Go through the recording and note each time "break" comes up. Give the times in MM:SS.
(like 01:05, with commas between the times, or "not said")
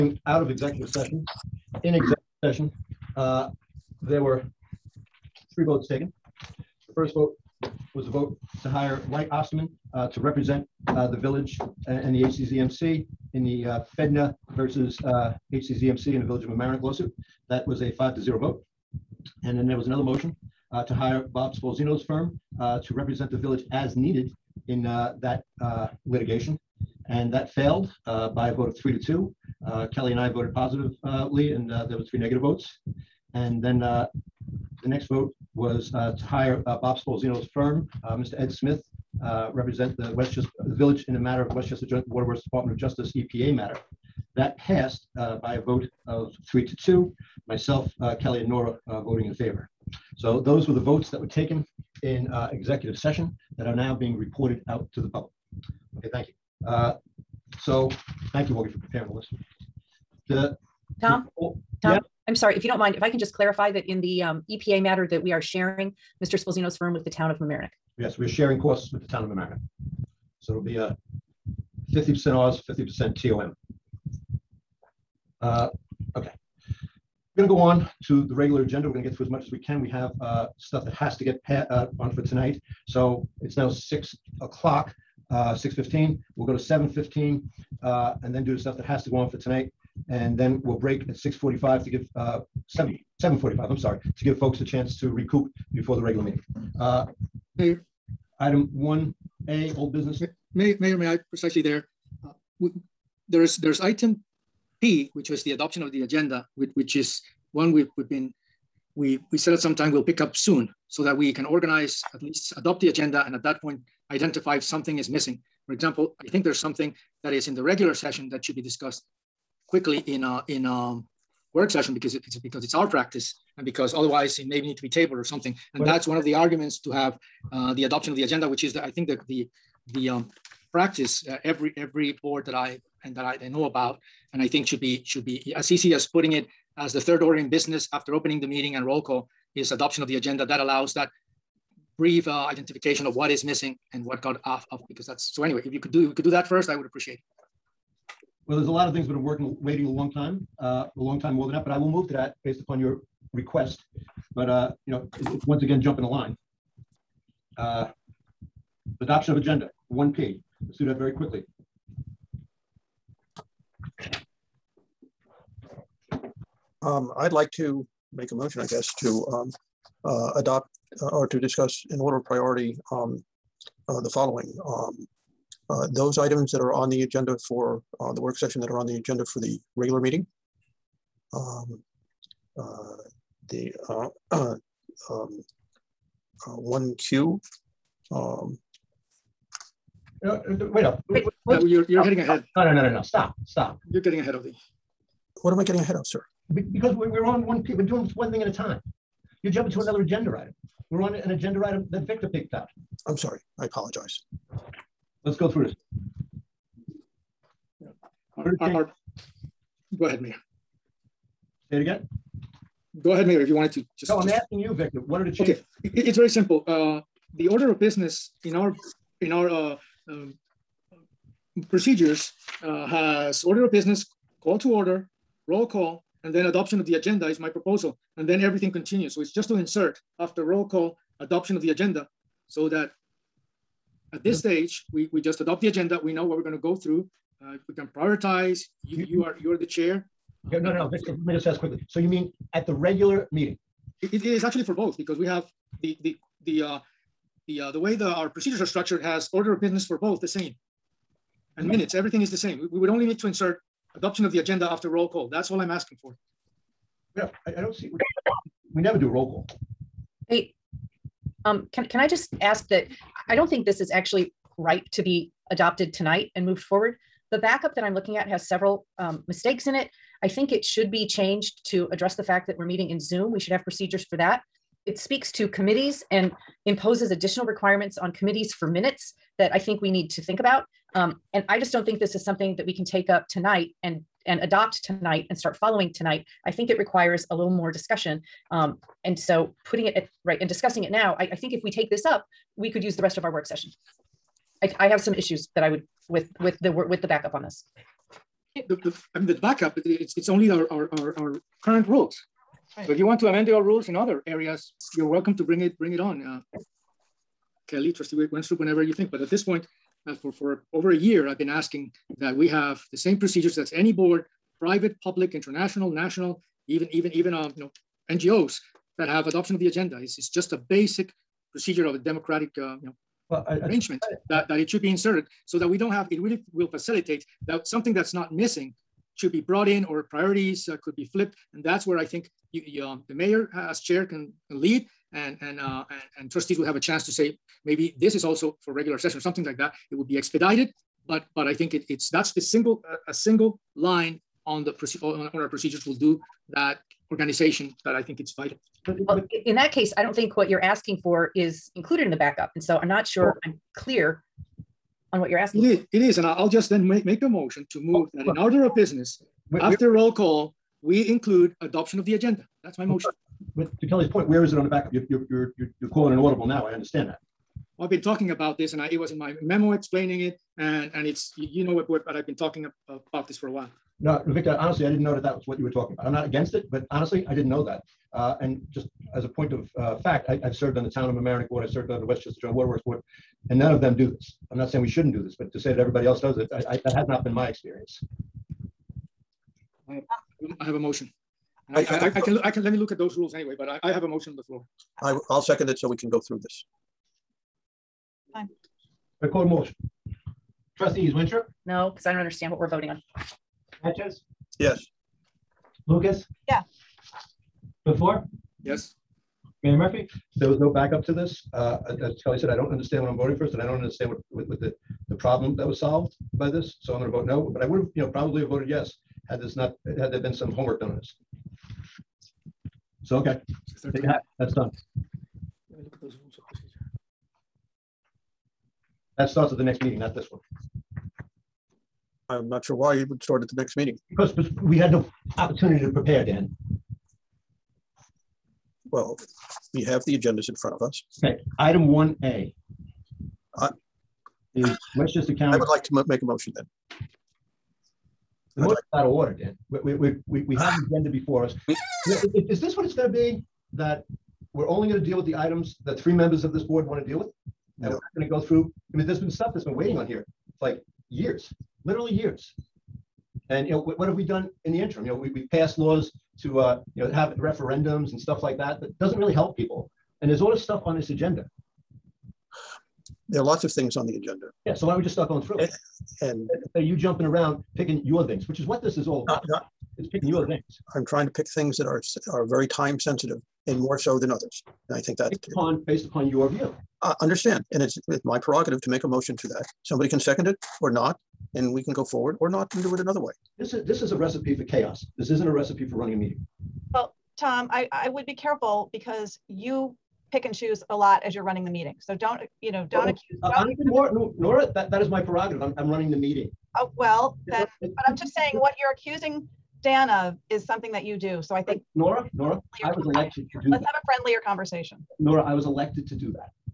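01:30.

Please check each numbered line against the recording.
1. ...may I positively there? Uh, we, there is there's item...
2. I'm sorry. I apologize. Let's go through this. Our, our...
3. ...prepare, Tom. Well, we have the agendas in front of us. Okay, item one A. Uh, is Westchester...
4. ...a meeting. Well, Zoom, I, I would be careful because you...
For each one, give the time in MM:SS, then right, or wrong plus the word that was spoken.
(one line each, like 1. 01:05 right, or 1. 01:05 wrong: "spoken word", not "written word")
1. 01:40 wrong: "precisely", not "positively"
2. 03:23 right
3. 07:15 wrong: "Dan", not "Tom"
4. 08:16 wrong: "Tom", not "Zoom".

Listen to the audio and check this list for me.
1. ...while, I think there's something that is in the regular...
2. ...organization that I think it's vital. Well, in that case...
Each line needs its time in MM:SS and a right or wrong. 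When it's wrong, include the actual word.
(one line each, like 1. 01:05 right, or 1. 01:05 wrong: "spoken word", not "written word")
1. 01:55 wrong: "example", not "while"
2. 05:47 right.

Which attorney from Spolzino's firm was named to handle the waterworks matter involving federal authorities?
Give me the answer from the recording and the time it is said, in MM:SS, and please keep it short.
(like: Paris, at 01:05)
Ed Smith, at 00:38.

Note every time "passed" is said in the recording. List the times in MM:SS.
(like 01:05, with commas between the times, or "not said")
00:44, 07:45.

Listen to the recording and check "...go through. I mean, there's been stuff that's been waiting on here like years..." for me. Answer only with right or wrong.
right.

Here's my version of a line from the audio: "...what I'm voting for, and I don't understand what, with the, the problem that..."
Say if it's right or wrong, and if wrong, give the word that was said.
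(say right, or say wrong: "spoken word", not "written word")
right.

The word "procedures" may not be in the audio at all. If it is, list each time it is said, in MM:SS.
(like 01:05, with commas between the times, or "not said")
03:41, 04:08, 04:33, 05:13, 05:21, 05:45, 07:06.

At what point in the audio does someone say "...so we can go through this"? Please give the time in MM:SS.
06:35.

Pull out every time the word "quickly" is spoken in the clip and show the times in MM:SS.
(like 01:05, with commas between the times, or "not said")
01:59, 02:41, 04:01.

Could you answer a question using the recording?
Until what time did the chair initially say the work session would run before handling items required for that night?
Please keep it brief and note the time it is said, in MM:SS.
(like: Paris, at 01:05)
7:15, at 01:26.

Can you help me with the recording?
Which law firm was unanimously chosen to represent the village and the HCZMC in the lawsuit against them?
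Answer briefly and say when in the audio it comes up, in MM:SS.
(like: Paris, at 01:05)
White Osterman, at 00:09.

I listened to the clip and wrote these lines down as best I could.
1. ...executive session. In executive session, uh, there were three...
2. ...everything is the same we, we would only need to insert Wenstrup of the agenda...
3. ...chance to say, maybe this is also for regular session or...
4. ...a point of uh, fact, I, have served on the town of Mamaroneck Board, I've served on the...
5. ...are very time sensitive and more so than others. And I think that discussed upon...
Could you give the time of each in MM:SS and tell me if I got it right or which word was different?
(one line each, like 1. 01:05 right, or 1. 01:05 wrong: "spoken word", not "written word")
1. 00:00 right
2. 04:11 wrong: "Adoption", not "Wenstrup"
3. 05:36 right
4. 06:19 right
5. 08:02 wrong: "based", not "discussed".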